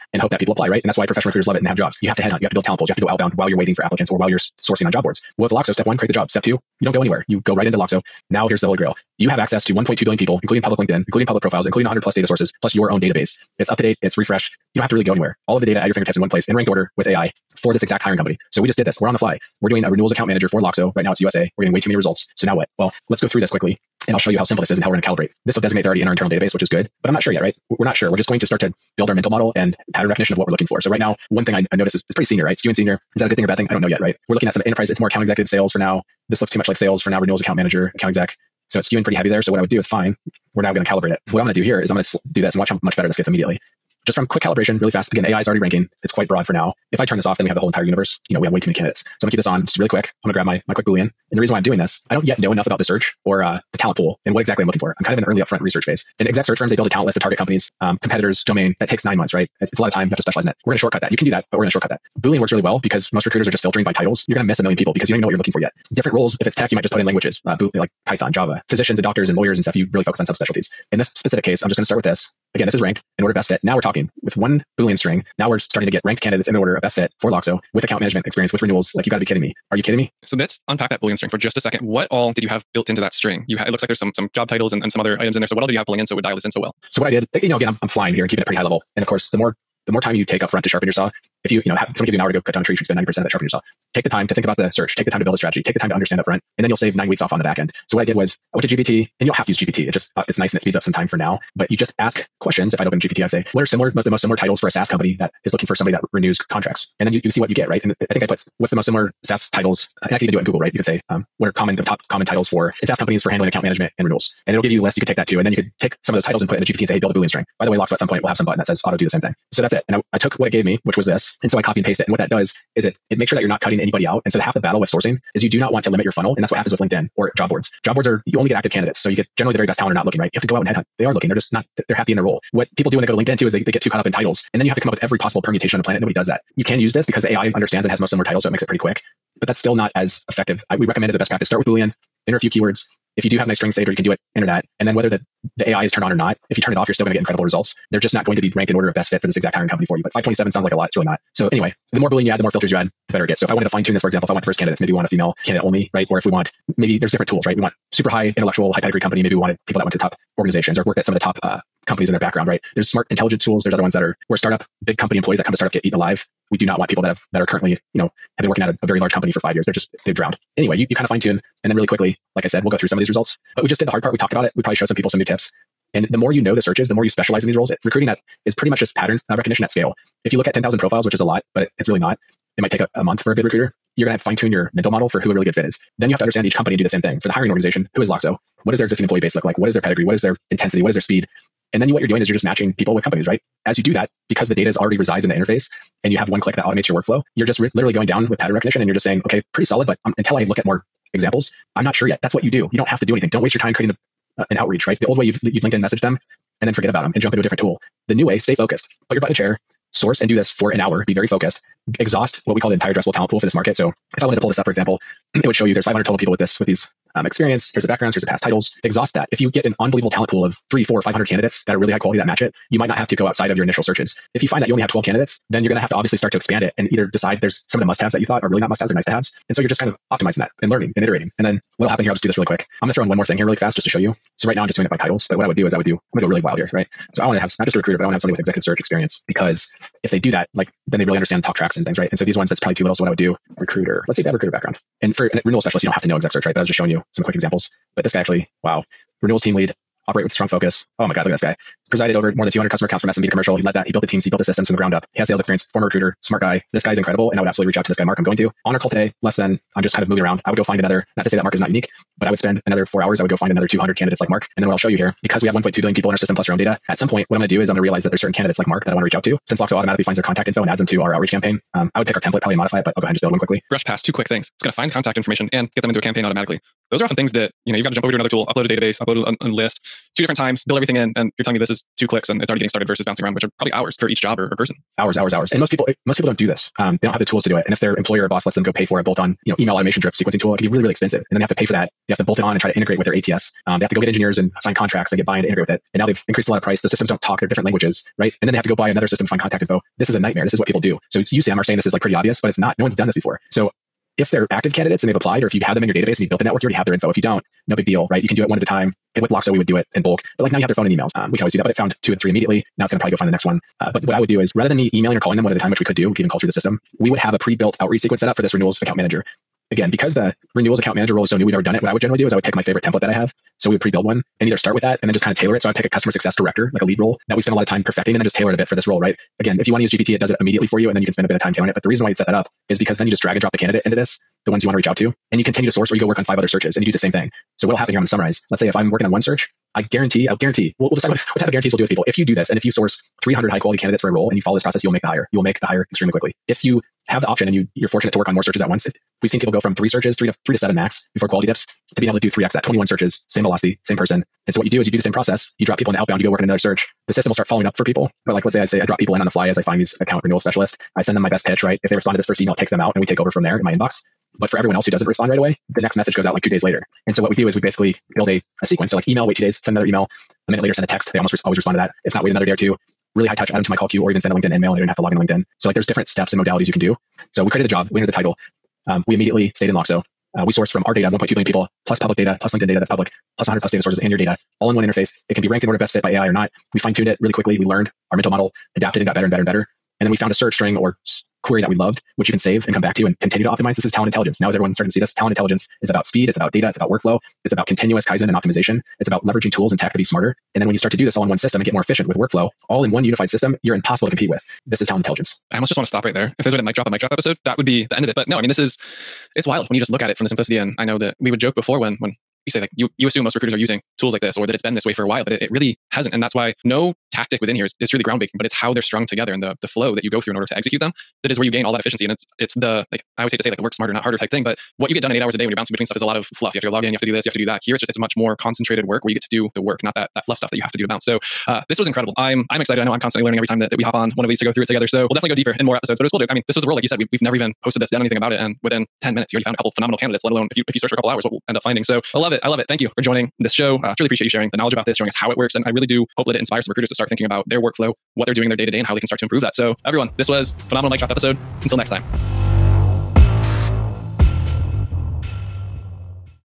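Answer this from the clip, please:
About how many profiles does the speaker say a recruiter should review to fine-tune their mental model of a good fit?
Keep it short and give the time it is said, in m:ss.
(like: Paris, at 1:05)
10,000, at 3:00.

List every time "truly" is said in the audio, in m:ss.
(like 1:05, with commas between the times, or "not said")
6:57, 7:23.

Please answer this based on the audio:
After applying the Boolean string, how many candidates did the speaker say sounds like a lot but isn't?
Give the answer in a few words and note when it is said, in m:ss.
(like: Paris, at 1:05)
527, at 2:30.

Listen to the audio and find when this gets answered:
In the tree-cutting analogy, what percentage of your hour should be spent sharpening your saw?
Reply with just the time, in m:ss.
1:32.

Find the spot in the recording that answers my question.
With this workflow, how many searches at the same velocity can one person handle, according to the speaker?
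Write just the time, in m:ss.
5:52.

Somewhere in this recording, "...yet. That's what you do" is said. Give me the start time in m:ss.
3:22.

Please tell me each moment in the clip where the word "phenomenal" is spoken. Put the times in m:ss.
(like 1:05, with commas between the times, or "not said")
7:19, 7:30.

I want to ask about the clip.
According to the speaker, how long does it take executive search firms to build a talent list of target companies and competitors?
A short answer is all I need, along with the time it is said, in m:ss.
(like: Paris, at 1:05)
9 months, at 0:59.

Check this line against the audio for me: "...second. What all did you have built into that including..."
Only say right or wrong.
wrong.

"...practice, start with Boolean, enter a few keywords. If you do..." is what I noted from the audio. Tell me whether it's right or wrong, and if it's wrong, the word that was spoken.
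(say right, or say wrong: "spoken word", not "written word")
right.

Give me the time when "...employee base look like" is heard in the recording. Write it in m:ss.
3:09.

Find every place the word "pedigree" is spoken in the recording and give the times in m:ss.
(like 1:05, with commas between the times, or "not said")
2:38, 3:09.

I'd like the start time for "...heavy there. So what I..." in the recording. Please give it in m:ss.
0:39.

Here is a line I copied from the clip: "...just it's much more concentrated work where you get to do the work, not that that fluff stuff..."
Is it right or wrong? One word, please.
right.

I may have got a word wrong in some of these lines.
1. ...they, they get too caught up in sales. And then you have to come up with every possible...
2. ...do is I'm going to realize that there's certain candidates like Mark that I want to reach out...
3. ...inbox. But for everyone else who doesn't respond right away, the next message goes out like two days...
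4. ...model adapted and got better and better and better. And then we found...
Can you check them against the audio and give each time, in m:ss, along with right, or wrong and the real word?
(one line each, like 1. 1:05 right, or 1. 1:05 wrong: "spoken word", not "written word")
1. 2:13 wrong: "titles", not "sales"
2. 4:27 right
3. 6:03 right
4. 6:28 right.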